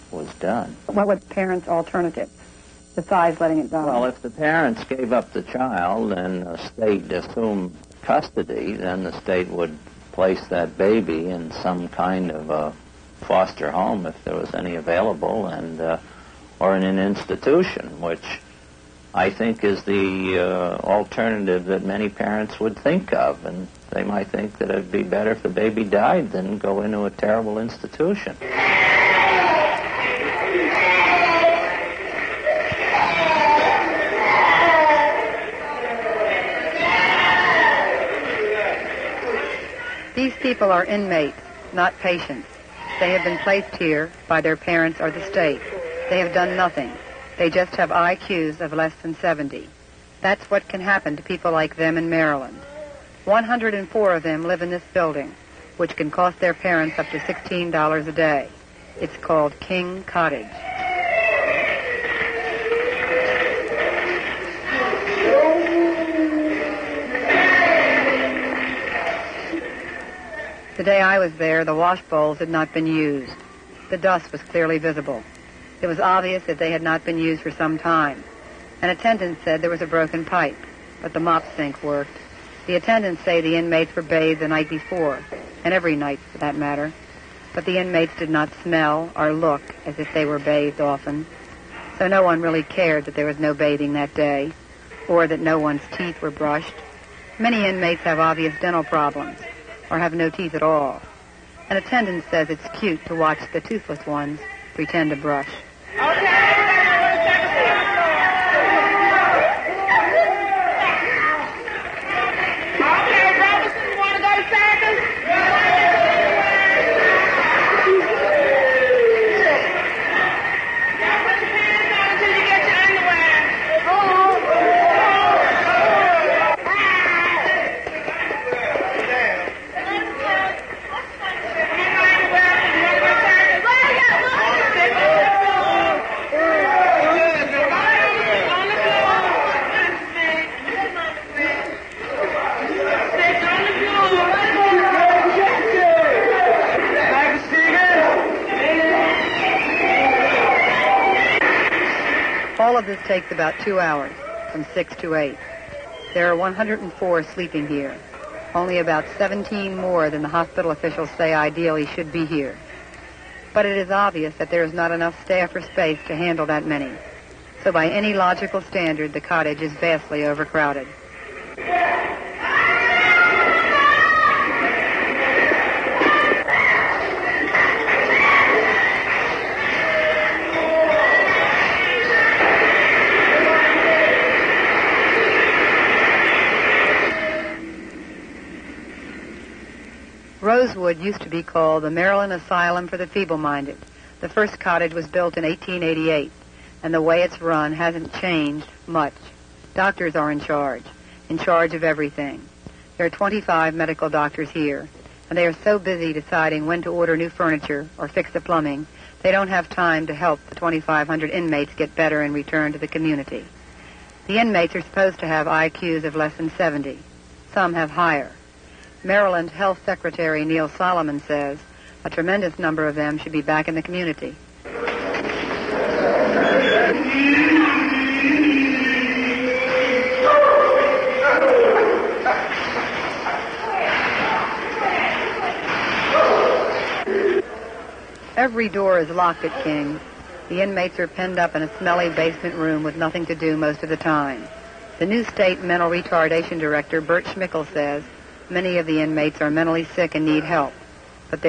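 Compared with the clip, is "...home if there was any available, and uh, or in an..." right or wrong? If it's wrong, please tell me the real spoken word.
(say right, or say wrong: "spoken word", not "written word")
right.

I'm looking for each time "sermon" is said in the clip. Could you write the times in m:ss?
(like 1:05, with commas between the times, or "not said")
not said.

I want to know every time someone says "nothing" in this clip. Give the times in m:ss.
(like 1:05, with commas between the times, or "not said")
0:46, 4:02.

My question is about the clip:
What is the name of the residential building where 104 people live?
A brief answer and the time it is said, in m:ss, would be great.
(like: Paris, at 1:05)
King Cottage, at 0:59.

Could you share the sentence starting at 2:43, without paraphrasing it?
But it is obvious that there is not enough staff or space to handle that many.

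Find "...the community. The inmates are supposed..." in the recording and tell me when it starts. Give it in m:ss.
3:32.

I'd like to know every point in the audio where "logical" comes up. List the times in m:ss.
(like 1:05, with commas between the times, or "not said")
2:48.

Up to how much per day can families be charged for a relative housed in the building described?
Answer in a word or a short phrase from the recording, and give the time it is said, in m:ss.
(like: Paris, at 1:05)
$16, at 0:57.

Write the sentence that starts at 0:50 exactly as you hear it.
That's what can happen to people like them in Maryland.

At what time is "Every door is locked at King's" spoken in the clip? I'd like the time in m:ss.
3:58.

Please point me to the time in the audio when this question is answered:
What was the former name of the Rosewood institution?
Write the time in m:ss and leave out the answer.
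3:11.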